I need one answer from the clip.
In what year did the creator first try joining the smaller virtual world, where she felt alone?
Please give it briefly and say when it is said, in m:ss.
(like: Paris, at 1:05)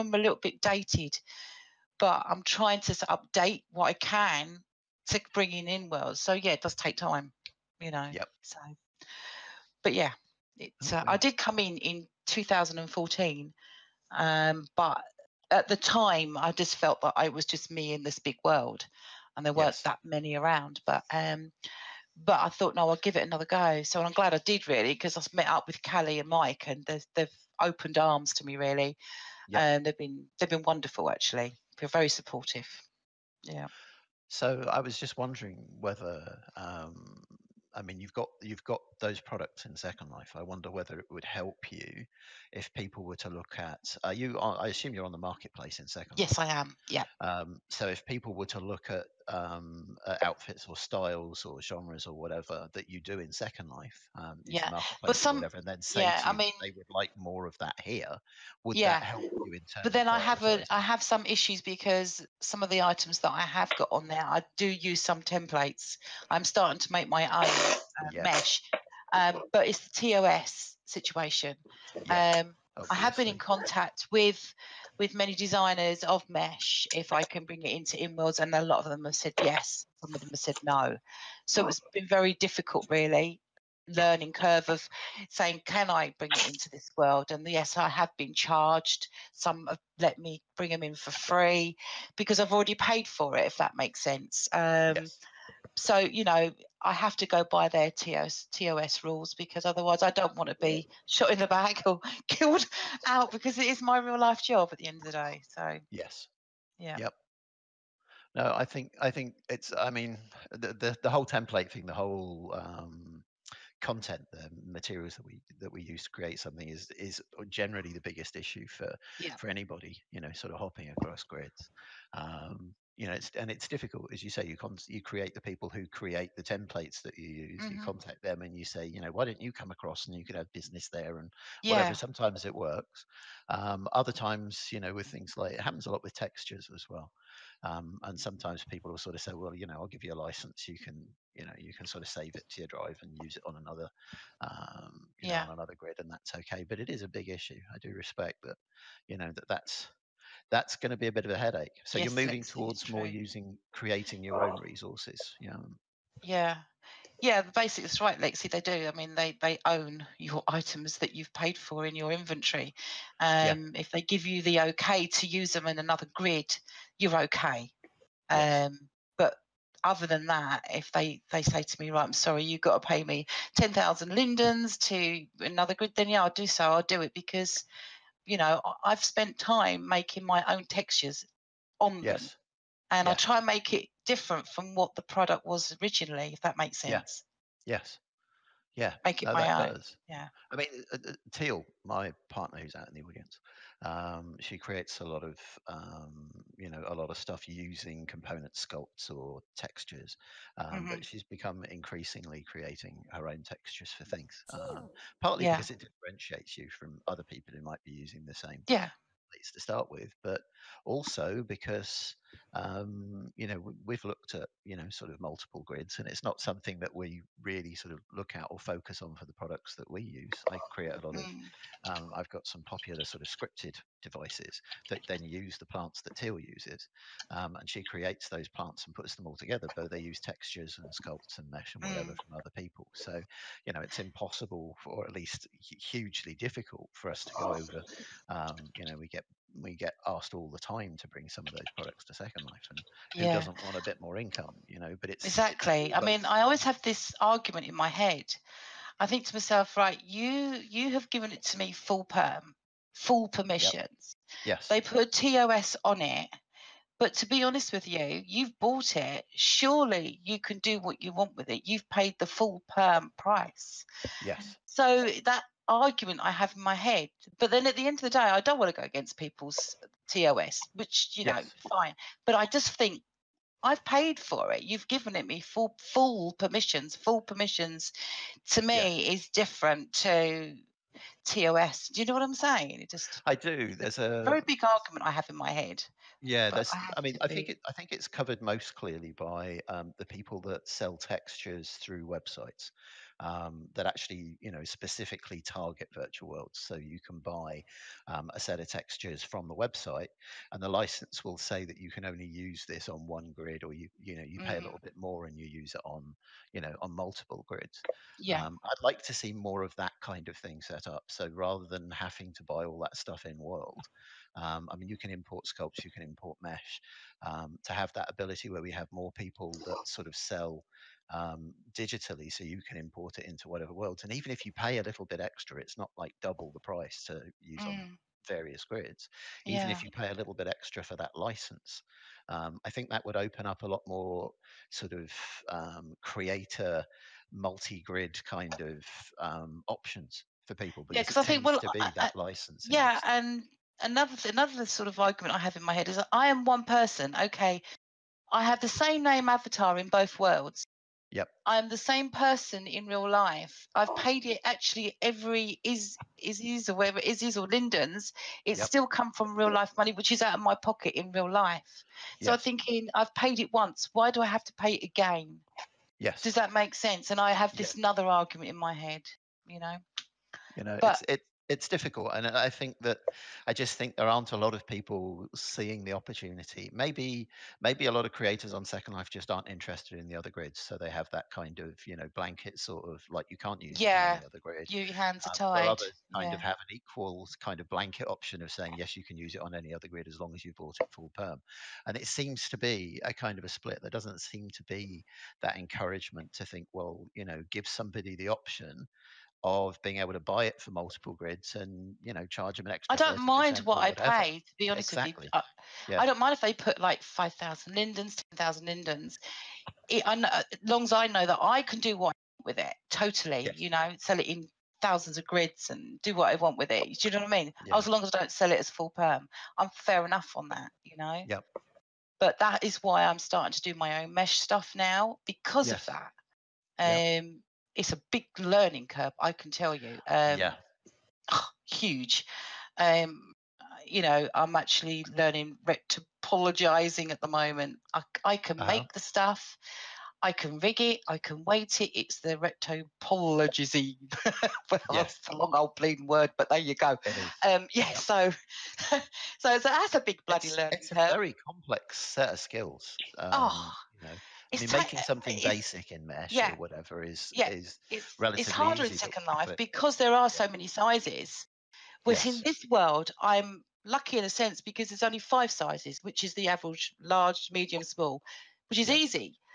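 2014, at 0:12.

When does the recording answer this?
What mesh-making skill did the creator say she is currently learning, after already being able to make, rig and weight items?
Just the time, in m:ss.
7:15.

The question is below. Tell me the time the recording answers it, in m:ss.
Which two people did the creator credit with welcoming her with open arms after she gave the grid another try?
0:25.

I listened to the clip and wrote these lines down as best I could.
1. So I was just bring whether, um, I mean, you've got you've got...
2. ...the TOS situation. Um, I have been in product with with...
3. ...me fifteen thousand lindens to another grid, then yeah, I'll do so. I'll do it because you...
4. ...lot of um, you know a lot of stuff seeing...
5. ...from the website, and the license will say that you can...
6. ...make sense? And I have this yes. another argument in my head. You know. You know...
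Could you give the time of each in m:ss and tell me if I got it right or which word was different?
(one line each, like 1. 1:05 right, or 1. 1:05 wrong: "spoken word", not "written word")
1. 0:34 wrong: "wondering", not "bring"
2. 1:09 wrong: "contact", not "product"
3. 2:53 wrong: "ten", not "fifteen"
4. 3:15 wrong: "using", not "seeing"
5. 4:59 right
6. 6:06 right.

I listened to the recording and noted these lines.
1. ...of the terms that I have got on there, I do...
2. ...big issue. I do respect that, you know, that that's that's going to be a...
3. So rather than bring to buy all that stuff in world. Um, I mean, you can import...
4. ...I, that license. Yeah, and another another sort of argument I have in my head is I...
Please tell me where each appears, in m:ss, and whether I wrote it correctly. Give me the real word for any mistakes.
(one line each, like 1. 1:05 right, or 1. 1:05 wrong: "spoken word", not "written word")
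1. 1:02 wrong: "items", not "terms"
2. 2:27 right
3. 5:11 wrong: "having", not "bring"
4. 5:41 right.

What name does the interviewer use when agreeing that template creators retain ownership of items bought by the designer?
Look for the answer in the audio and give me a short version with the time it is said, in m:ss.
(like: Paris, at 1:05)
Lexi, at 2:38.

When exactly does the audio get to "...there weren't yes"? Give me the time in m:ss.
0:19.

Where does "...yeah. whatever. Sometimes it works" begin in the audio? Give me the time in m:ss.
2:11.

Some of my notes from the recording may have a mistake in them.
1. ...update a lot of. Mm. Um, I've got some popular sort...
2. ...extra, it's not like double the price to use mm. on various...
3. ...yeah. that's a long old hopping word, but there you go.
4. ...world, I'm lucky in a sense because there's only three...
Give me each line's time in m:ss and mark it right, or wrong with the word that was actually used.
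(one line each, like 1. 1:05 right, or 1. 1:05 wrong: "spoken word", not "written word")
1. 3:40 wrong: "create", not "update"
2. 5:25 right
3. 7:24 wrong: "bleeding", not "hopping"
4. 7:42 wrong: "five", not "three".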